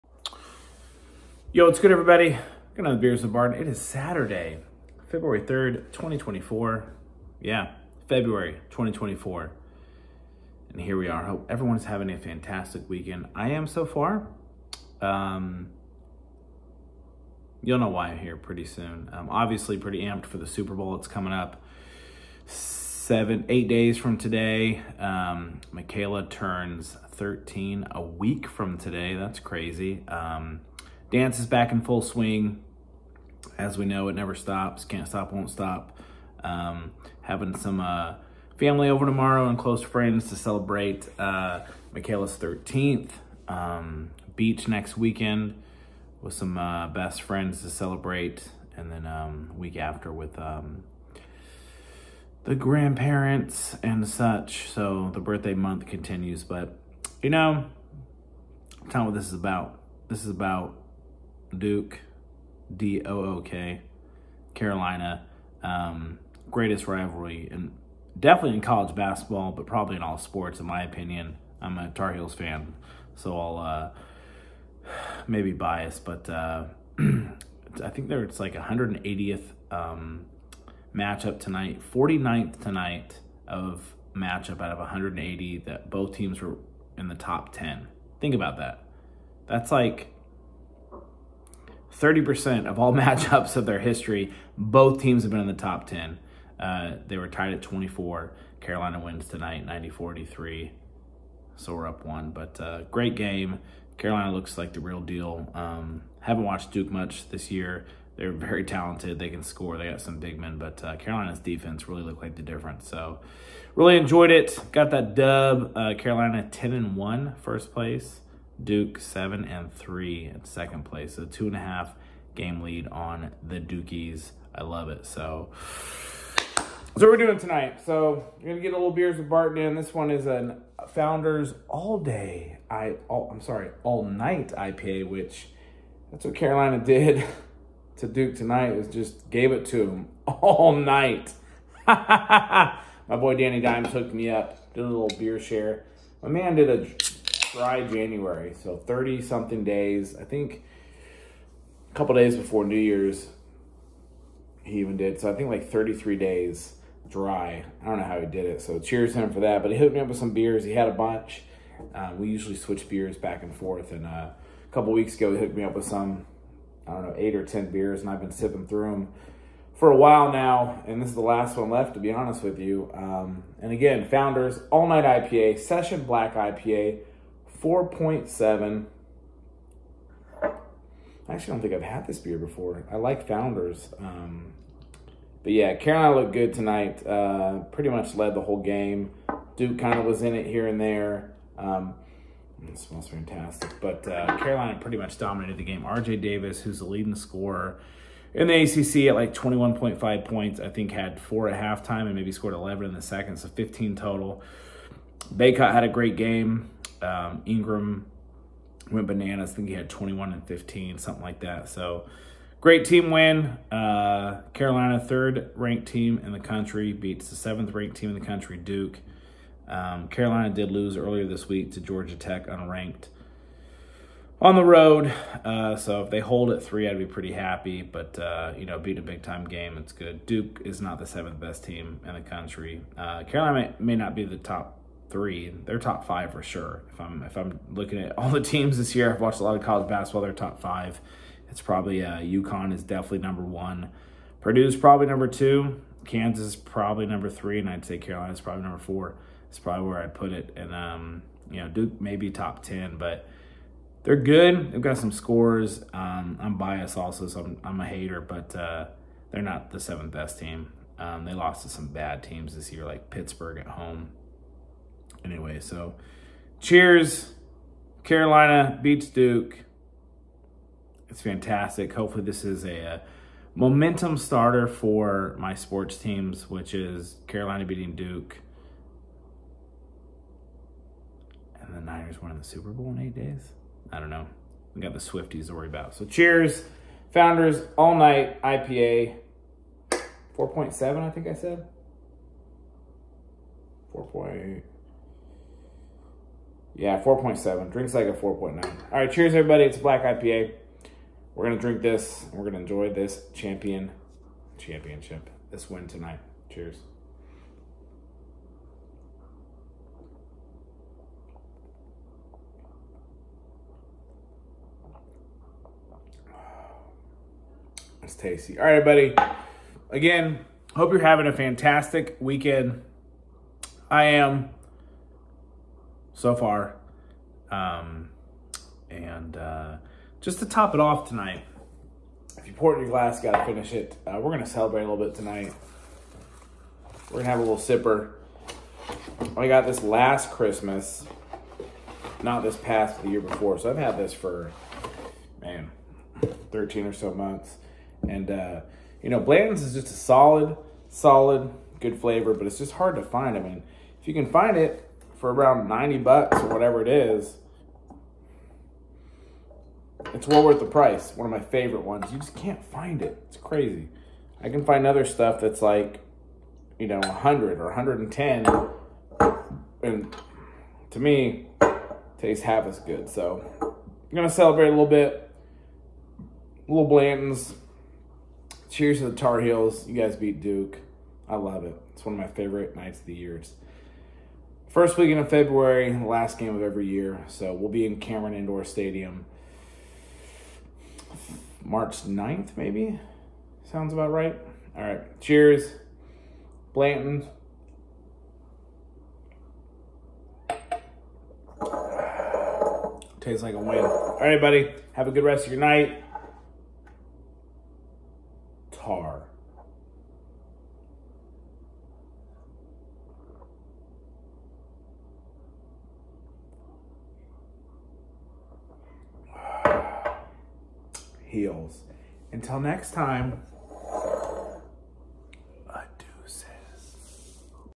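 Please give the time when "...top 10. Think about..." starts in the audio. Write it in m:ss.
1:27.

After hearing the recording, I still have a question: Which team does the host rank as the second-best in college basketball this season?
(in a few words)
Purdue.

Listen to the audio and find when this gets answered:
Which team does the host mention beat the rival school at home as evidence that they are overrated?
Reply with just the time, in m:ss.
4:23.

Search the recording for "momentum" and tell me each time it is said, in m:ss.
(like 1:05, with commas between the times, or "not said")
4:33.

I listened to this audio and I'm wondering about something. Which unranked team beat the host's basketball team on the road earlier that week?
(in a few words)
Georgia Tech.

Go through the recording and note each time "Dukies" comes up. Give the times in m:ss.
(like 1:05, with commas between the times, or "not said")
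2:03.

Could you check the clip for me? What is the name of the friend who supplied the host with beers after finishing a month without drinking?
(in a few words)
Danny Dimes.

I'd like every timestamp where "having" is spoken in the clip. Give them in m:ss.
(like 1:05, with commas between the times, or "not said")
0:11, 0:37, 5:21.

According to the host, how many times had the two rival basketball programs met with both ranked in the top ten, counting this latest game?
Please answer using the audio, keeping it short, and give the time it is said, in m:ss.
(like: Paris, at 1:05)
49, at 1:21.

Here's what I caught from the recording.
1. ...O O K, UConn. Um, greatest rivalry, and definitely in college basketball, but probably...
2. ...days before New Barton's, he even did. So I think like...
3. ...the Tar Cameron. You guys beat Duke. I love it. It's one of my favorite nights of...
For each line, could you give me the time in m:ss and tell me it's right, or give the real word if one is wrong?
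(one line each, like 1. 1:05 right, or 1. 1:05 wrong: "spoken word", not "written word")
1. 1:03 wrong: "Carolina", not "UConn"
2. 2:32 wrong: "Year", not "Barton"
3. 6:19 wrong: "Heels", not "Cameron".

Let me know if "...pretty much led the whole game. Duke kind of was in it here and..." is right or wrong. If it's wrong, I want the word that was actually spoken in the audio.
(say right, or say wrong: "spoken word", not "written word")
right.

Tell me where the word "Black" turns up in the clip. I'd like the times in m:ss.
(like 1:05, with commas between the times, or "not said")
2:56, 4:59.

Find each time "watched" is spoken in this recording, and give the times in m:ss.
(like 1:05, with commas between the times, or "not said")
1:46, 3:59.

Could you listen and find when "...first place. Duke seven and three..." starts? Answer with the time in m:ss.
1:57.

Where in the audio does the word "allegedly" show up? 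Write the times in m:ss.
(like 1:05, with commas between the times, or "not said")
not said.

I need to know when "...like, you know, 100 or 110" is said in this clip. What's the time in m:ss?
6:05.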